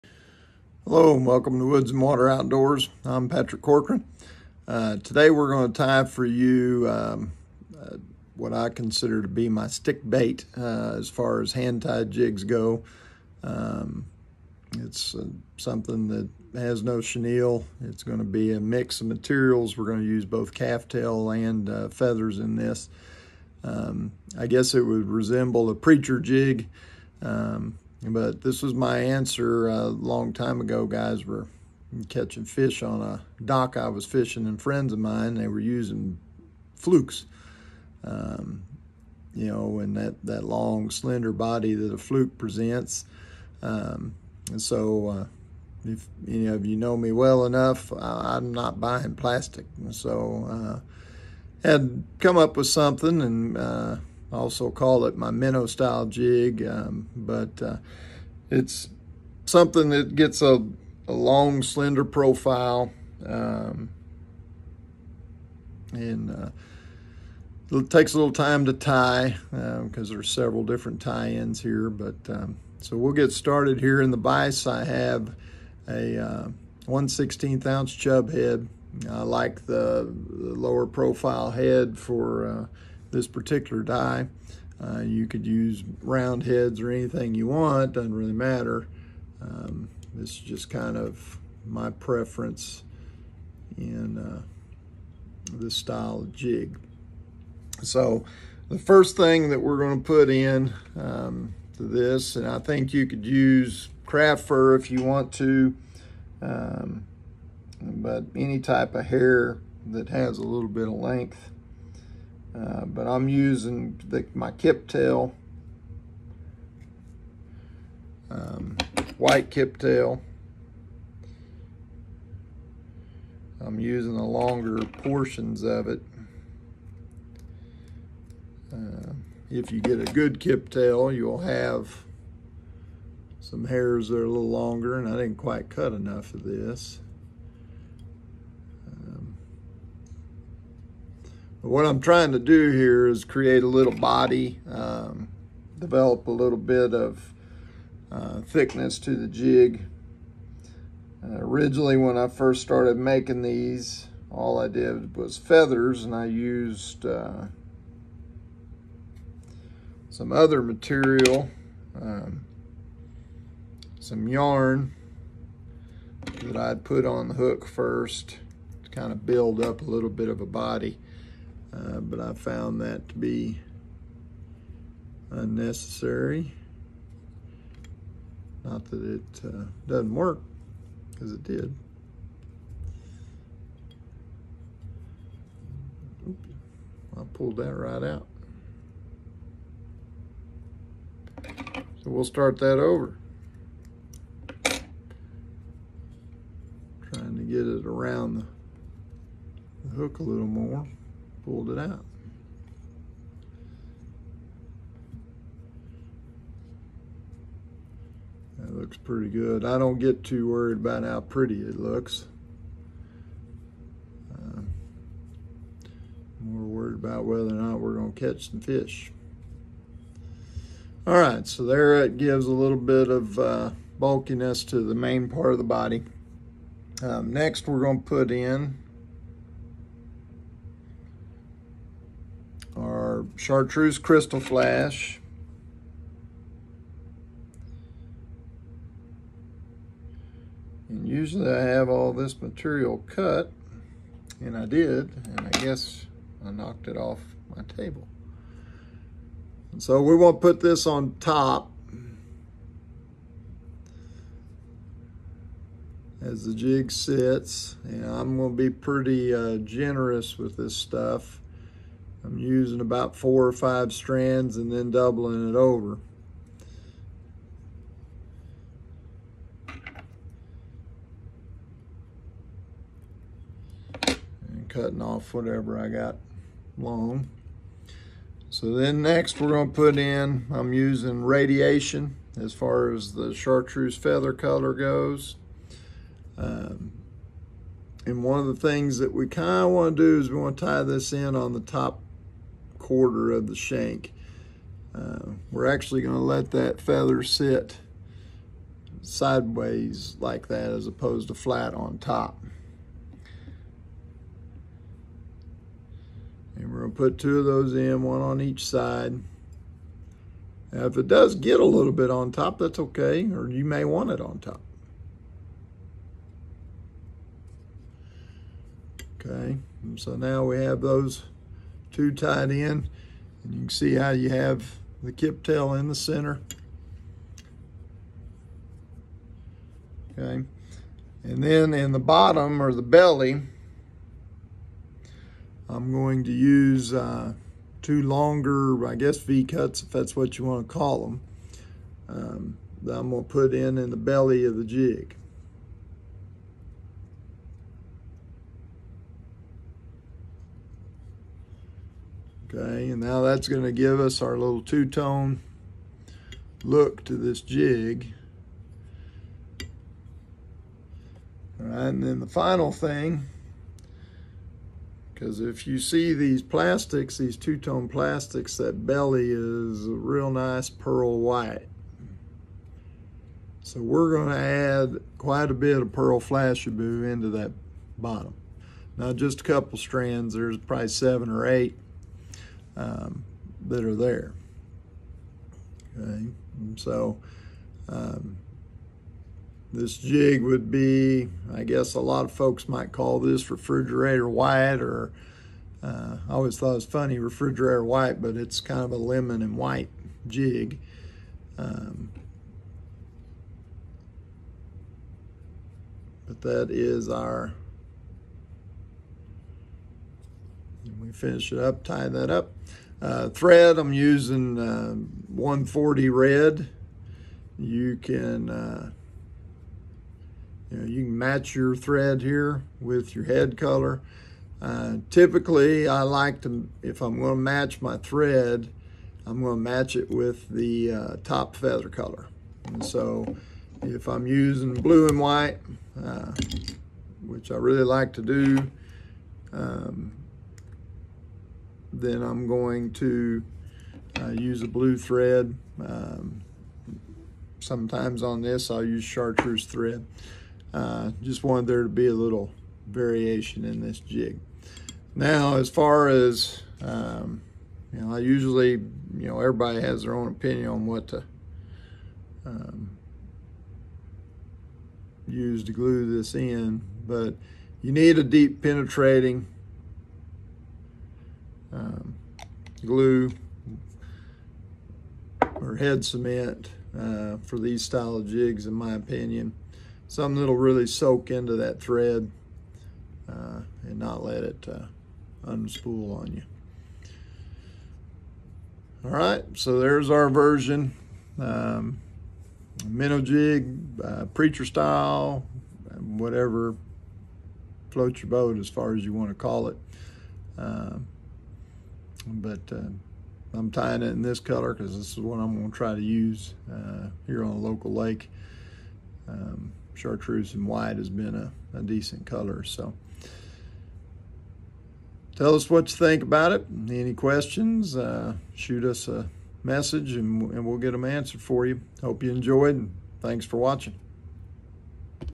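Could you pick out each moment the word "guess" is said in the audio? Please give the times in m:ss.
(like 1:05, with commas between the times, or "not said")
0:24, 4:05, 5:38, 6:31.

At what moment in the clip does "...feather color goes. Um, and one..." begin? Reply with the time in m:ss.
4:43.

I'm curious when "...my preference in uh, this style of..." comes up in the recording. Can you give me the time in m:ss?
1:31.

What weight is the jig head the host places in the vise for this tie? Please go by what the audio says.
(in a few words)
1/16 ounce.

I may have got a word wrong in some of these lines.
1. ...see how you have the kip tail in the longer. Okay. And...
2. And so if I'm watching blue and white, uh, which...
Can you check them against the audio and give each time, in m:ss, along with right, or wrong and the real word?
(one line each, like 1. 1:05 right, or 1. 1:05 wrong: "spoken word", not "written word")
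1. 5:23 wrong: "center", not "longer"
2. 7:12 wrong: "using", not "watching".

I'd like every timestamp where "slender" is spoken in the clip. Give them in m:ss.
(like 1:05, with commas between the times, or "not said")
0:40, 1:01.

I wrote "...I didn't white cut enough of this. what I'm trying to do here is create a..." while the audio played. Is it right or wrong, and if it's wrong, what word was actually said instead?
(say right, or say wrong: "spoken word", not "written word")
wrong: "quite", not "white".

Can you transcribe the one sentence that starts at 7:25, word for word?
Um, sometimes on this I'll use chartreuse thread.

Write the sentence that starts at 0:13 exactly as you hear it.
Um, it's uh, something that has no chenille.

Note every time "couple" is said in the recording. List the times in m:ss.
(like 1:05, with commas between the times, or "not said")
6:19.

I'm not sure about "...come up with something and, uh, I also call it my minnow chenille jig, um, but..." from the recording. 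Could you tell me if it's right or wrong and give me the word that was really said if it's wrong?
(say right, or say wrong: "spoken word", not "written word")
wrong: "style", not "chenille".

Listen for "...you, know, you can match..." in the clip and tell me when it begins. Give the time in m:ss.
7:00.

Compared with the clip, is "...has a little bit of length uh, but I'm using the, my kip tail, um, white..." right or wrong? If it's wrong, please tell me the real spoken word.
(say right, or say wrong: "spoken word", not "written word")
right.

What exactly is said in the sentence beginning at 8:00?
Something that'll really soak into that thread uh, and not let it uh, unspool on you.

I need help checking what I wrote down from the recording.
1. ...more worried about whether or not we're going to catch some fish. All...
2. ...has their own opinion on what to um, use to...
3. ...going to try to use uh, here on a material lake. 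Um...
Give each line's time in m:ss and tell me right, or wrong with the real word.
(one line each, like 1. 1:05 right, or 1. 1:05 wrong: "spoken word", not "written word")
1. 3:36 right
2. 7:39 right
3. 8:25 wrong: "local", not "material".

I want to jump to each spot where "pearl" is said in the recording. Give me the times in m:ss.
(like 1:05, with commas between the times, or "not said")
6:10, 6:15.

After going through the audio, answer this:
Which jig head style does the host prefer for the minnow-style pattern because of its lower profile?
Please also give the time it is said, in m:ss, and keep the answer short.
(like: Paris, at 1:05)
Chub head, at 1:17.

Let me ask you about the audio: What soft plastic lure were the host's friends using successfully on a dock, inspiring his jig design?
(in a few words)
Flukes.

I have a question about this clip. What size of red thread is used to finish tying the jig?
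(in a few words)
140.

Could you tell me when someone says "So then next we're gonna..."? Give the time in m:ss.
4:38.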